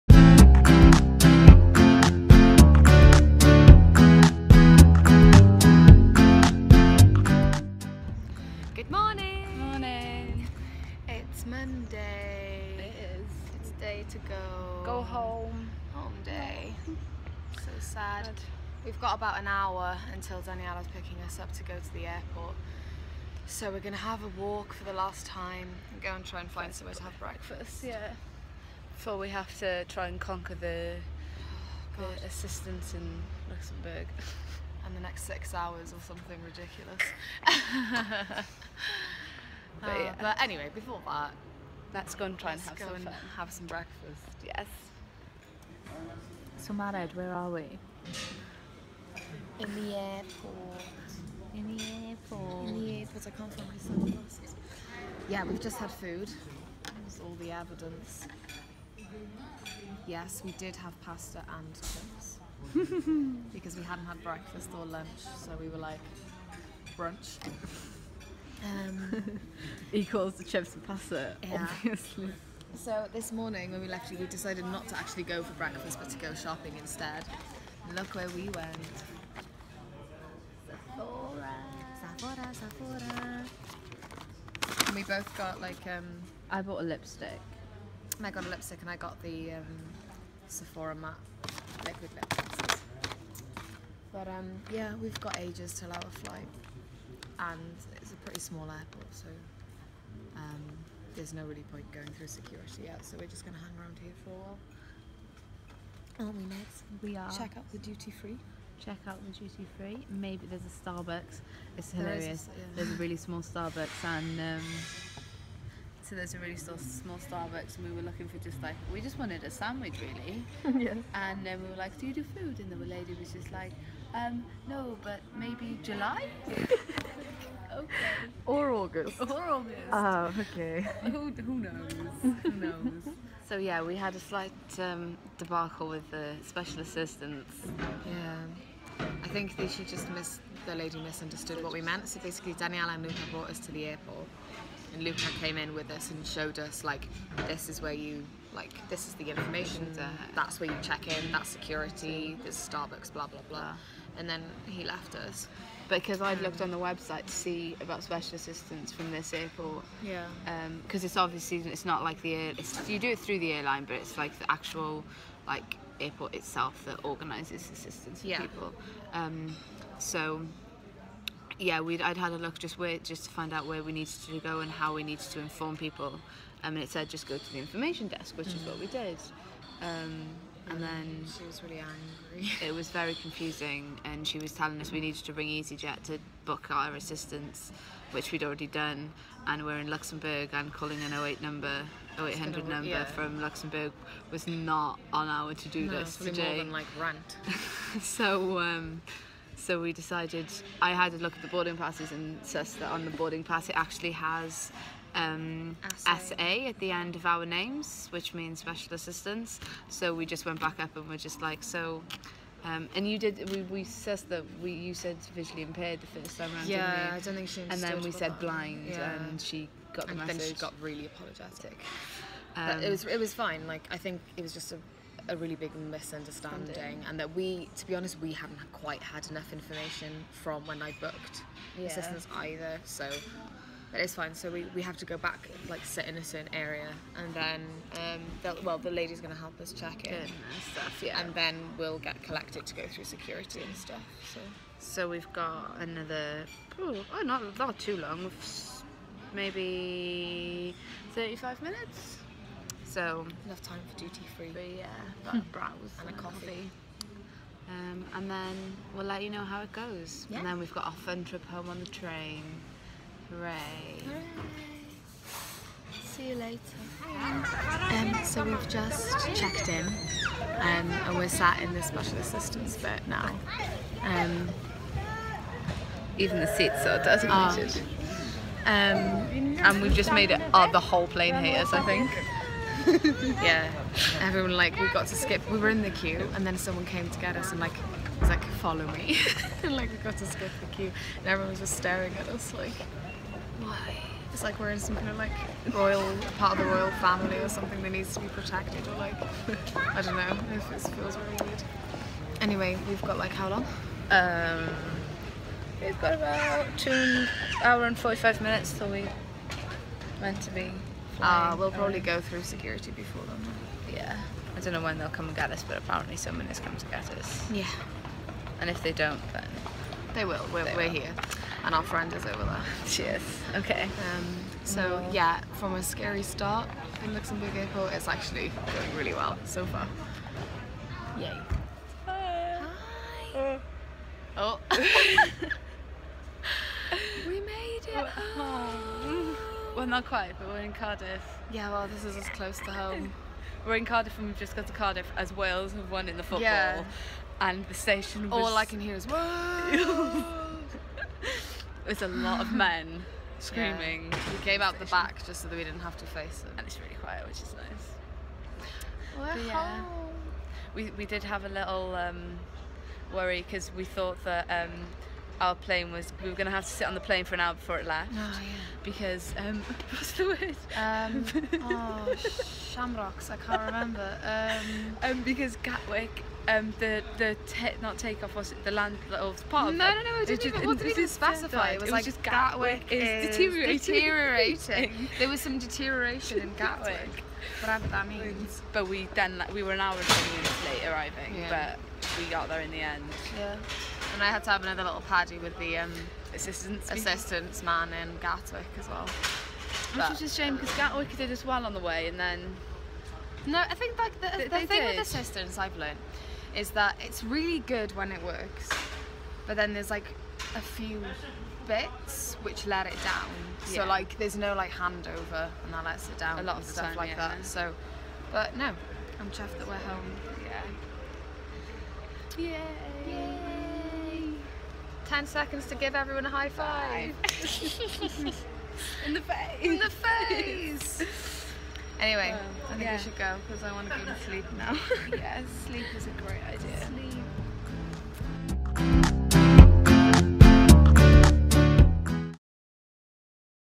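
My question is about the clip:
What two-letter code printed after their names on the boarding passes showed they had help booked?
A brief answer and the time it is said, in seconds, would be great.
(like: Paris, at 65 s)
SA, at 205 s.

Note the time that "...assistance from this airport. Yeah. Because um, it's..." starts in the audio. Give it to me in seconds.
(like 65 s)
158 s.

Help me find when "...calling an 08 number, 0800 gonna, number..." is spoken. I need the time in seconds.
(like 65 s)
190 s.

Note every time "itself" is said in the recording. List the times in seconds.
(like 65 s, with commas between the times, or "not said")
166 s.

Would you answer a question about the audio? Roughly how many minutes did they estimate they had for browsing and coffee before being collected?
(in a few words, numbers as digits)
35.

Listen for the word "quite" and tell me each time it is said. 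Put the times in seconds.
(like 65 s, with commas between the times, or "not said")
228 s, 340 s.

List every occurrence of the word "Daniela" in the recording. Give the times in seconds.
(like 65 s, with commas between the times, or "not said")
20 s, 142 s.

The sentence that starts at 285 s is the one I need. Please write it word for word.
We were in the queue, and then someone came to get us and like was like, follow me.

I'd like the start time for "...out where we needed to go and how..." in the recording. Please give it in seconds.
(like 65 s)
173 s.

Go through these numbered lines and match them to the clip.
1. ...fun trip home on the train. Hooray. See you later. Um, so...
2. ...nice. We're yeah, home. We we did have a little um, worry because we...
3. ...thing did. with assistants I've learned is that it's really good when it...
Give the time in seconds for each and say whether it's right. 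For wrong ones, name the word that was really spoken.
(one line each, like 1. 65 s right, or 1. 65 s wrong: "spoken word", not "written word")
1. 260 s right
2. 357 s right
3. 404 s right.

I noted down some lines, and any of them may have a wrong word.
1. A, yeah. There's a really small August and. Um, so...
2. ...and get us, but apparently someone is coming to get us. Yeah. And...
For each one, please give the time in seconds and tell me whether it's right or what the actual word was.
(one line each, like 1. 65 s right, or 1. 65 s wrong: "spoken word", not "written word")
1. 112 s wrong: "Starbucks", not "August"
2. 315 s right.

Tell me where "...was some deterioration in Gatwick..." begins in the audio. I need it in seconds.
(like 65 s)
385 s.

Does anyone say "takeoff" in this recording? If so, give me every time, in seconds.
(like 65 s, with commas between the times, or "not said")
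377 s.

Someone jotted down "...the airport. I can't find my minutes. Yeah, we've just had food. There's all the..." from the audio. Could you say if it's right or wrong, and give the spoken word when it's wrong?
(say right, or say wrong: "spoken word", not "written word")
wrong: "sunglasses", not "minutes".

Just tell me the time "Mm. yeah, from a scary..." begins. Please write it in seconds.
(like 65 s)
325 s.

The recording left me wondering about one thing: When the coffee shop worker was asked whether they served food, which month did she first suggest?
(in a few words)
July.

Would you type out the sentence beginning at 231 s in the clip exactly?
assistance either so but it's fine.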